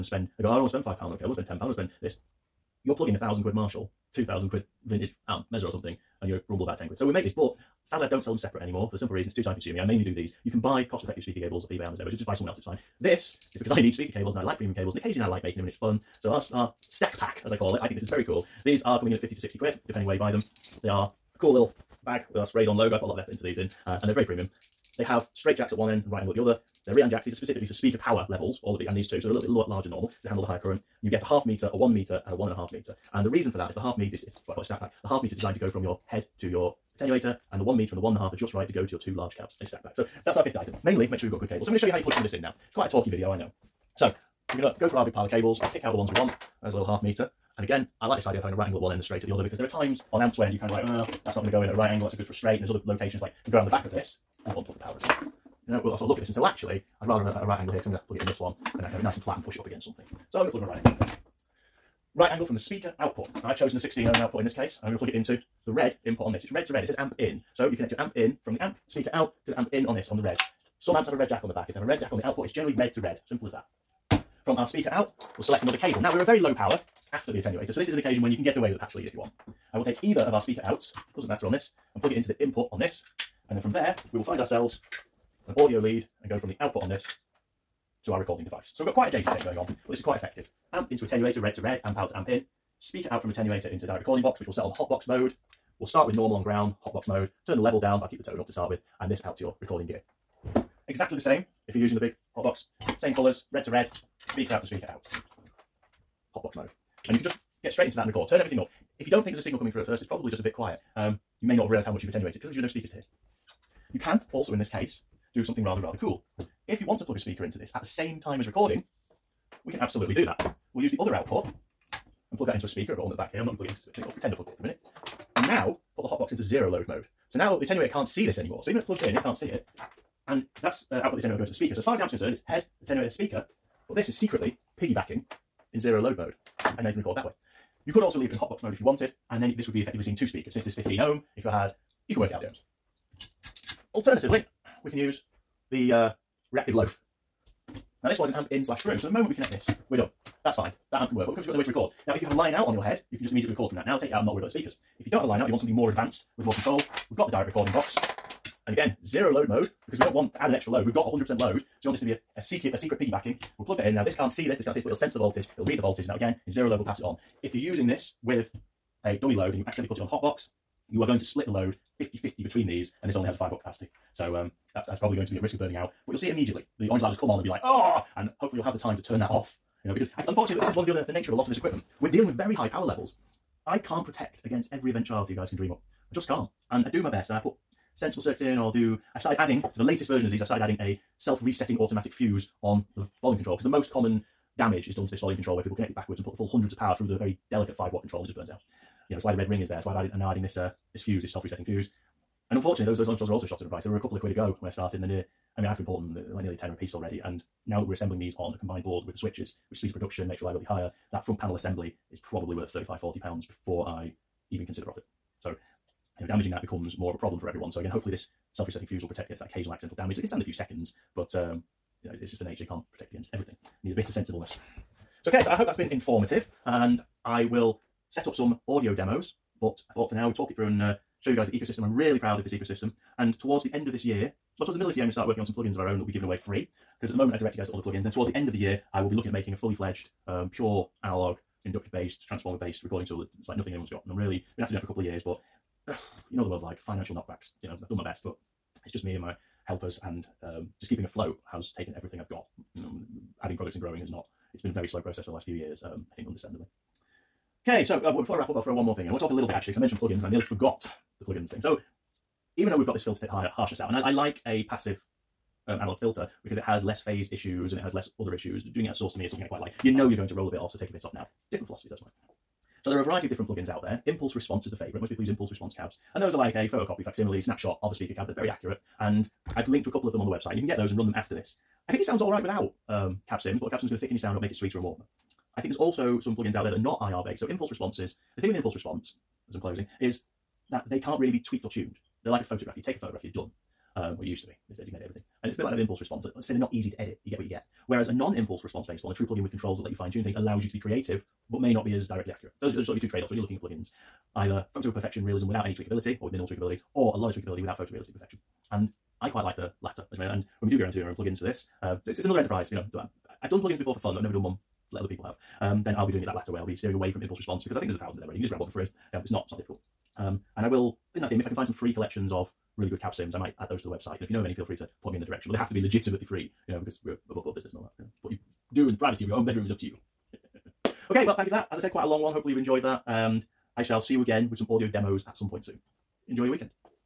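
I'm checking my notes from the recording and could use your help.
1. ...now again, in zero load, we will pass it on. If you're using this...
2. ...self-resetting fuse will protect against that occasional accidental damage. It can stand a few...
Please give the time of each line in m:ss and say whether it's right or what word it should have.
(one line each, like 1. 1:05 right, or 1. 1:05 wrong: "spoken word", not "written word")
1. 2:46 right
2. 3:38 right.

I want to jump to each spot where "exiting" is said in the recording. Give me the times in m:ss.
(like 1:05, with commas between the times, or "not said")
not said.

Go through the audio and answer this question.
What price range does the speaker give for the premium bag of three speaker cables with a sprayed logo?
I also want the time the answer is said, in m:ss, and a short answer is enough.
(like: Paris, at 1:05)
50 to 60 pounds, at 0:19.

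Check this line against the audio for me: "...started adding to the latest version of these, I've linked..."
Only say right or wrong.
wrong.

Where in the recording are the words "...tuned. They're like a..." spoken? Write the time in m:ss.
4:51.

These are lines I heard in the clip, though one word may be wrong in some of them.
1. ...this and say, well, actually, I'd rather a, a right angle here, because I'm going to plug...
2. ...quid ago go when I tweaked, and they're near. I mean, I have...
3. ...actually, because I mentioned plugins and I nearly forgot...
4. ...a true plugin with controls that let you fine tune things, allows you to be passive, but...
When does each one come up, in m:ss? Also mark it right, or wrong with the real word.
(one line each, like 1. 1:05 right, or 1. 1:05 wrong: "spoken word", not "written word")
1. 0:56 right
2. 3:24 wrong: "started", not "tweaked"
3. 4:19 right
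4. 4:59 wrong: "creative", not "passive".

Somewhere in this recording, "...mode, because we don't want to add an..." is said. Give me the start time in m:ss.
2:39.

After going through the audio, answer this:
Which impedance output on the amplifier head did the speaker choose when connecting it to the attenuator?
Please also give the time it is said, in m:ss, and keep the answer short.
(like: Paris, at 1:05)
16 ohm, at 1:03.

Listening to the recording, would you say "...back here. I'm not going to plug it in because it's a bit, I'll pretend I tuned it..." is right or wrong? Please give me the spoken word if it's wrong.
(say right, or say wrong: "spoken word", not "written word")
wrong: "plugged", not "tuned".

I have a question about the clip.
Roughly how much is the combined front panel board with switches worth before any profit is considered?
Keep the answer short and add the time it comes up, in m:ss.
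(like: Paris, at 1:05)
35-40 pounds, at 3:32.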